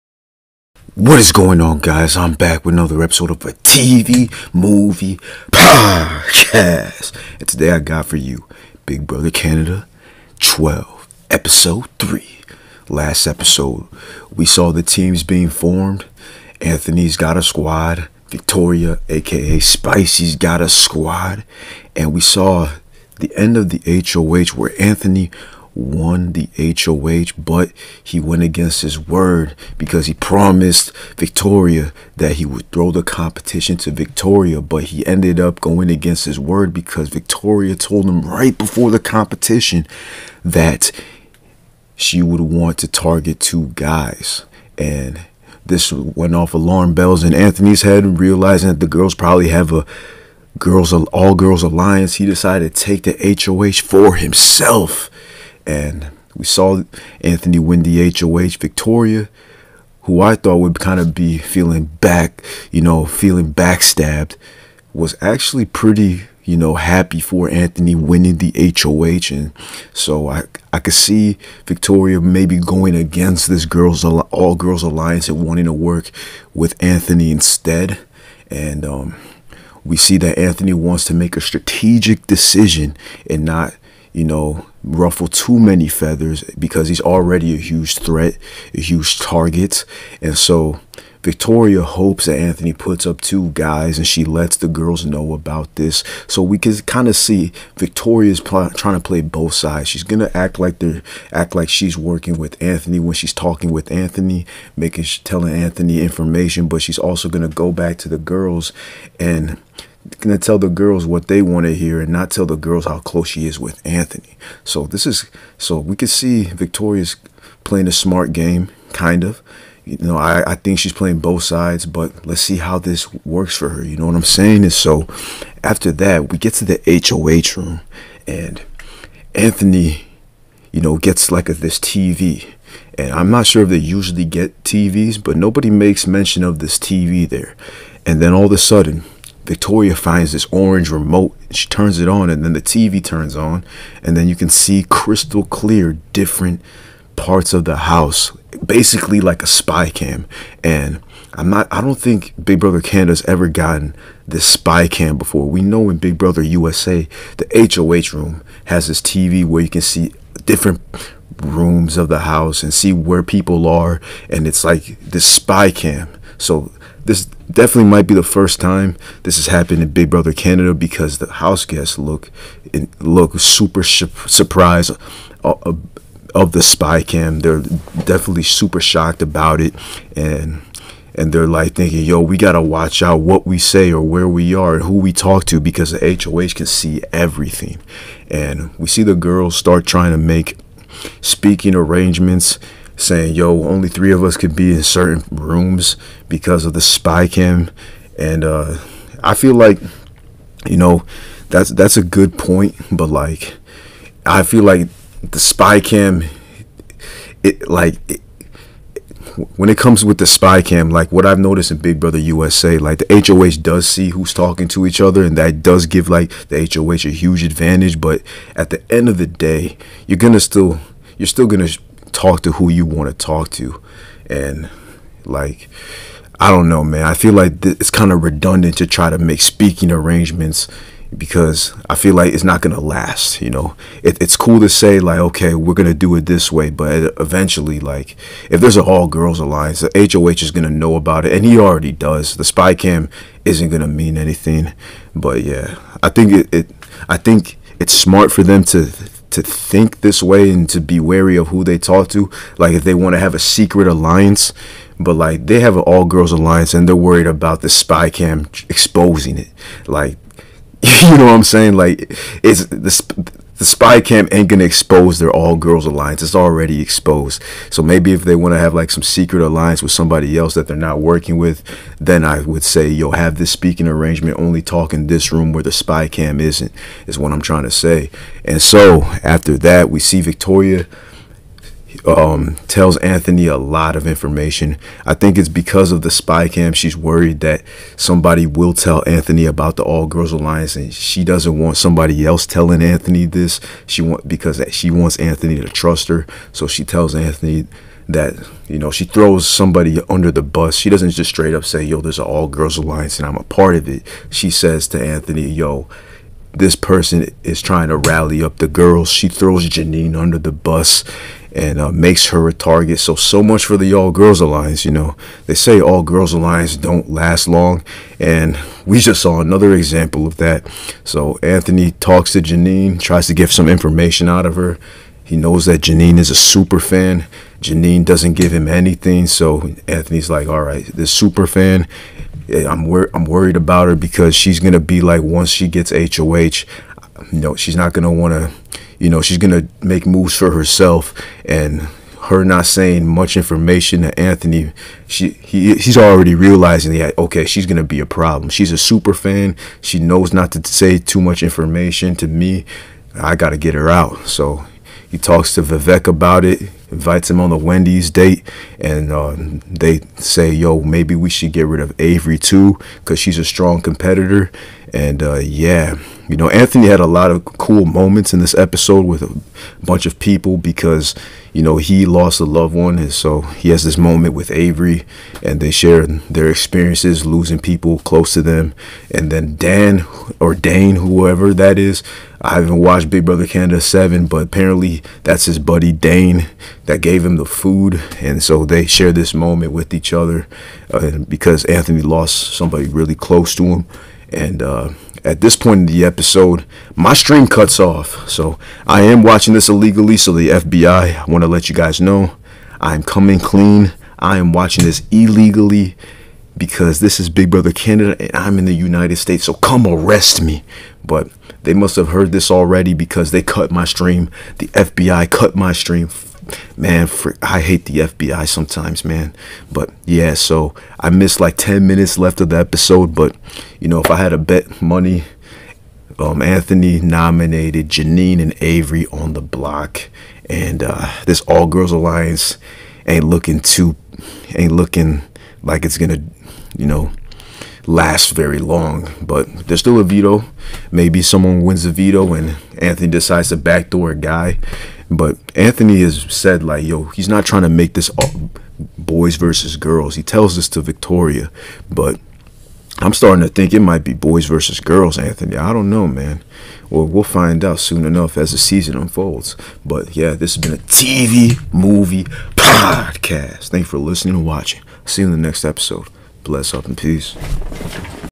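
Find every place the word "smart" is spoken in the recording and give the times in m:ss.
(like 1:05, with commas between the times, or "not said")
1:57, 4:07.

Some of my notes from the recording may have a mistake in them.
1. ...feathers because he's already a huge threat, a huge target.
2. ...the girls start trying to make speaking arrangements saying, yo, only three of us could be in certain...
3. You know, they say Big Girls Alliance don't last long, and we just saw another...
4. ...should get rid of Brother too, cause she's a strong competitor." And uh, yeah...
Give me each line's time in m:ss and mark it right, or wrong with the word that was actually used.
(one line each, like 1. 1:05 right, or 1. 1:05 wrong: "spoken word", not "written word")
1. 1:25 right
2. 3:09 right
3. 5:14 wrong: "All", not "Big"
4. 6:01 wrong: "Avery", not "Brother".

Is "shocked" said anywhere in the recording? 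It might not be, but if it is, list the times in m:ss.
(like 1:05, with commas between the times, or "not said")
2:58.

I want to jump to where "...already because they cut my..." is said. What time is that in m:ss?
6:52.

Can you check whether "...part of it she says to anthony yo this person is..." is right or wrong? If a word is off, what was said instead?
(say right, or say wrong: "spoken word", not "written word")
right.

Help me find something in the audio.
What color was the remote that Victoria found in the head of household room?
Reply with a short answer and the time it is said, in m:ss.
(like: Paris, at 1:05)
Orange, at 2:20.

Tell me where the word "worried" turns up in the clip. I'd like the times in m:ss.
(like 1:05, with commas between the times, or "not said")
4:16, 4:46, 5:33.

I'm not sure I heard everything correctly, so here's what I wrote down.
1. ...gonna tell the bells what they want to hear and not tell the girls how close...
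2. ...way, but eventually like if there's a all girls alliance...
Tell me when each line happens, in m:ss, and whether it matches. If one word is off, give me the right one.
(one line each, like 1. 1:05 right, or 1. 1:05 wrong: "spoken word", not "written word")
1. 1:50 wrong: "girls", not "bells"
2. 3:56 right.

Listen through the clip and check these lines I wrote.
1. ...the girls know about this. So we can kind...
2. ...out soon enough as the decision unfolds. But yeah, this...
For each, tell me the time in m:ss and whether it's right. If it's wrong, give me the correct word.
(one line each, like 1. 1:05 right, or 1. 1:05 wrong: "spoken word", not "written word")
1. 1:34 right
2. 7:37 wrong: "season", not "decision".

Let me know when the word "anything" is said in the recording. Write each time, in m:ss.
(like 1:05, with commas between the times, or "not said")
4:04, 5:28.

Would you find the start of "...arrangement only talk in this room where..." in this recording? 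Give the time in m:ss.
4:33.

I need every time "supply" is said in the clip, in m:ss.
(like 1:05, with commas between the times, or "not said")
not said.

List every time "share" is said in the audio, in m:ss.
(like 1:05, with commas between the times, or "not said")
6:15, 6:28.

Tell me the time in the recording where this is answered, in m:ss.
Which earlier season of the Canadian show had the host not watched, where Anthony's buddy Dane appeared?
6:23.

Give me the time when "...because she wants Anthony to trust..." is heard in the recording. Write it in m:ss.
4:54.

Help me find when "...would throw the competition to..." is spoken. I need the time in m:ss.
0:32.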